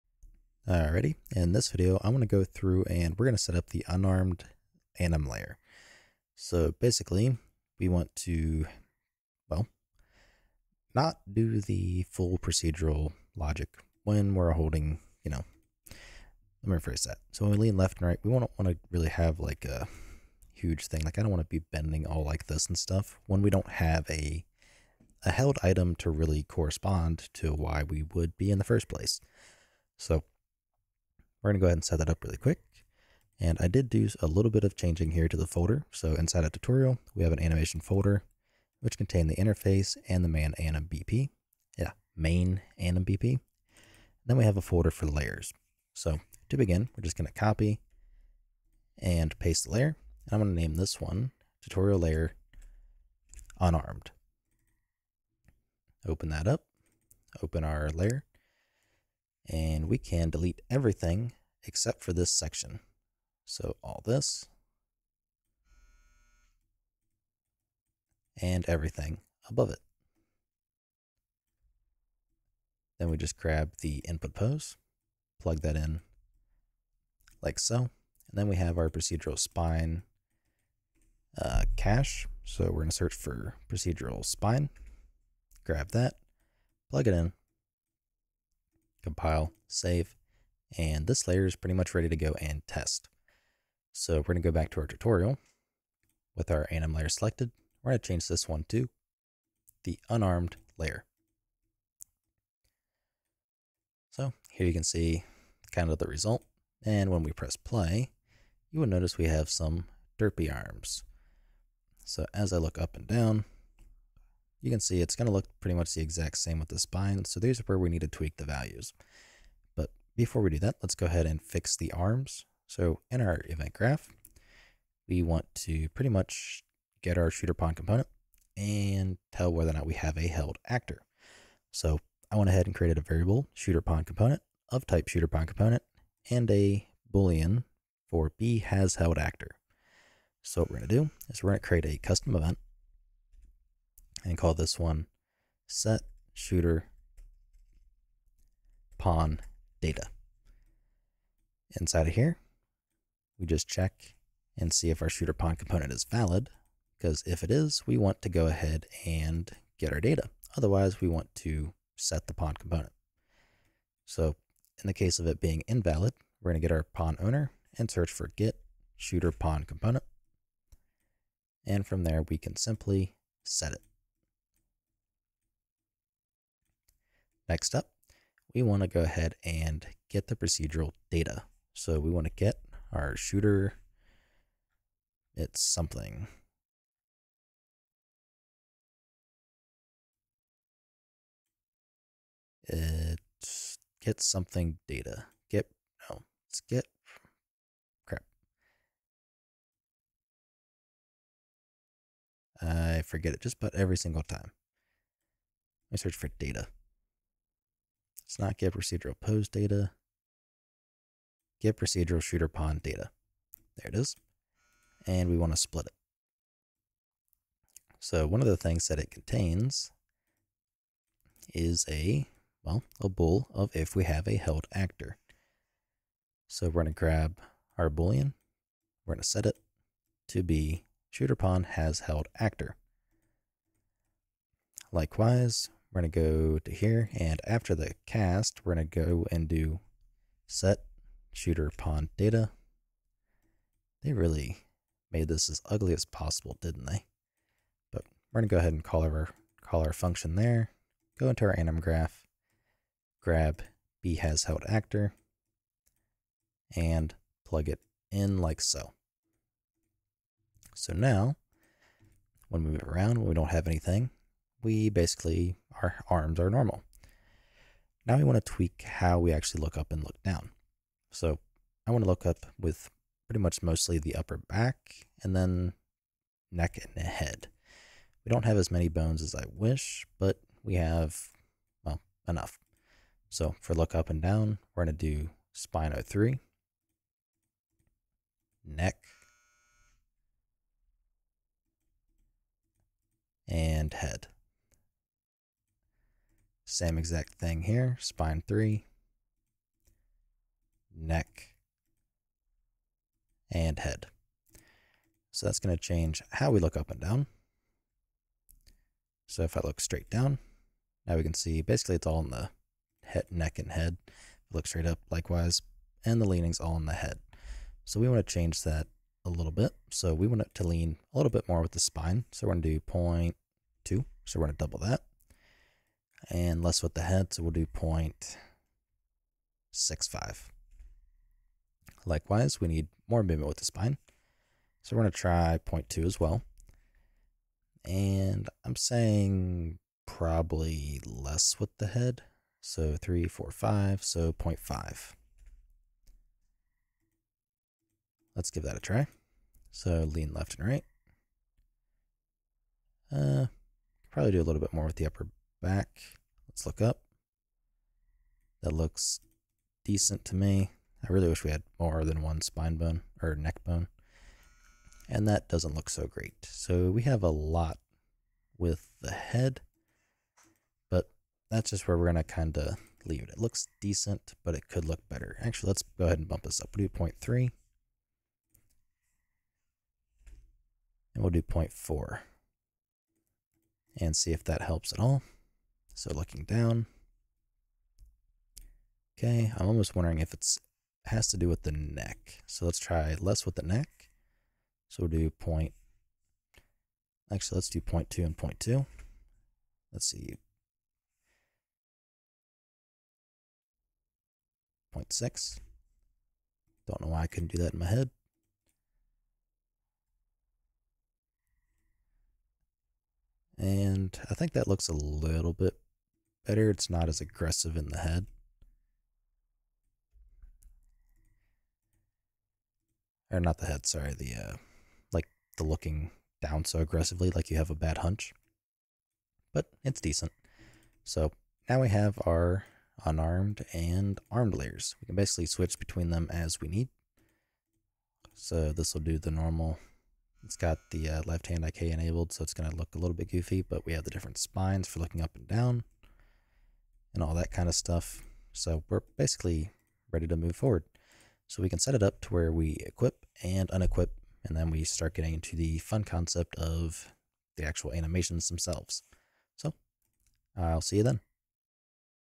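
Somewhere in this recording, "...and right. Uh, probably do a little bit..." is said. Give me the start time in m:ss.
5:50.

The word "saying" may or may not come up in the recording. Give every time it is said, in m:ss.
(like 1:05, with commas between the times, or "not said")
5:38.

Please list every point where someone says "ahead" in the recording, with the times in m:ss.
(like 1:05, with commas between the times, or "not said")
0:31, 2:01, 2:12, 2:38, 2:59, 4:08, 6:16.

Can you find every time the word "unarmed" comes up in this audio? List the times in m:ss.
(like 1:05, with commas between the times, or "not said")
0:03, 0:53, 1:40, 7:13.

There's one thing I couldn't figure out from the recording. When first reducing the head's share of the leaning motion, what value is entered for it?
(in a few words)
0.65.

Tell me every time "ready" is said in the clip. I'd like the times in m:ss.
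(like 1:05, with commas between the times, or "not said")
1:31, 7:30.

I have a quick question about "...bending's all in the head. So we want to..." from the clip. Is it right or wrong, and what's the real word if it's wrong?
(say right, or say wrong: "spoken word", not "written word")
wrong: "leaning", not "bending".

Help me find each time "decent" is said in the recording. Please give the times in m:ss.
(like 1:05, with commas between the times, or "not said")
5:59, 6:13, 7:10.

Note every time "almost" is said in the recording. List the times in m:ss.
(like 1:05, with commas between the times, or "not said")
6:29.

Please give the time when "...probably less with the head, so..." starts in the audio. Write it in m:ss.
5:40.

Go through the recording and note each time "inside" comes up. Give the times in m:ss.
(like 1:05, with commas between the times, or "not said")
0:36, 2:31.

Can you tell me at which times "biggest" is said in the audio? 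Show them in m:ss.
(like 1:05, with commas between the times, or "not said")
not said.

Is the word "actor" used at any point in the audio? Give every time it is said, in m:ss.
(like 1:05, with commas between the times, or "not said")
2:10, 2:19, 3:44, 3:52, 4:14.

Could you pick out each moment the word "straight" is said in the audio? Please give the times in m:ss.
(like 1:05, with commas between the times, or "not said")
5:09, 5:14.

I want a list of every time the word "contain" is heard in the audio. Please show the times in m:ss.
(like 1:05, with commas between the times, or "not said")
0:38, 3:39.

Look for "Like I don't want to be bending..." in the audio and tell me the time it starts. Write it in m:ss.
0:21.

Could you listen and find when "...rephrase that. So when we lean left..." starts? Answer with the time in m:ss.
0:16.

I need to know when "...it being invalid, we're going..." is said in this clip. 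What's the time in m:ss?
2:45.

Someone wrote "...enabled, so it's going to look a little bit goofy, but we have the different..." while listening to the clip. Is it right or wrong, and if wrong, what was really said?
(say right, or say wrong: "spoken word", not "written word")
right.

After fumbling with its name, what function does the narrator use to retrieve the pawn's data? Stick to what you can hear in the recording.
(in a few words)
Get procedural shooter pawn data.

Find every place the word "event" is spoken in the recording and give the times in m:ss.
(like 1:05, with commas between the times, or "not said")
2:03, 2:22.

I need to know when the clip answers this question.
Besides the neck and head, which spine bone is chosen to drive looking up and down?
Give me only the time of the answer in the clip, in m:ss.
4:45.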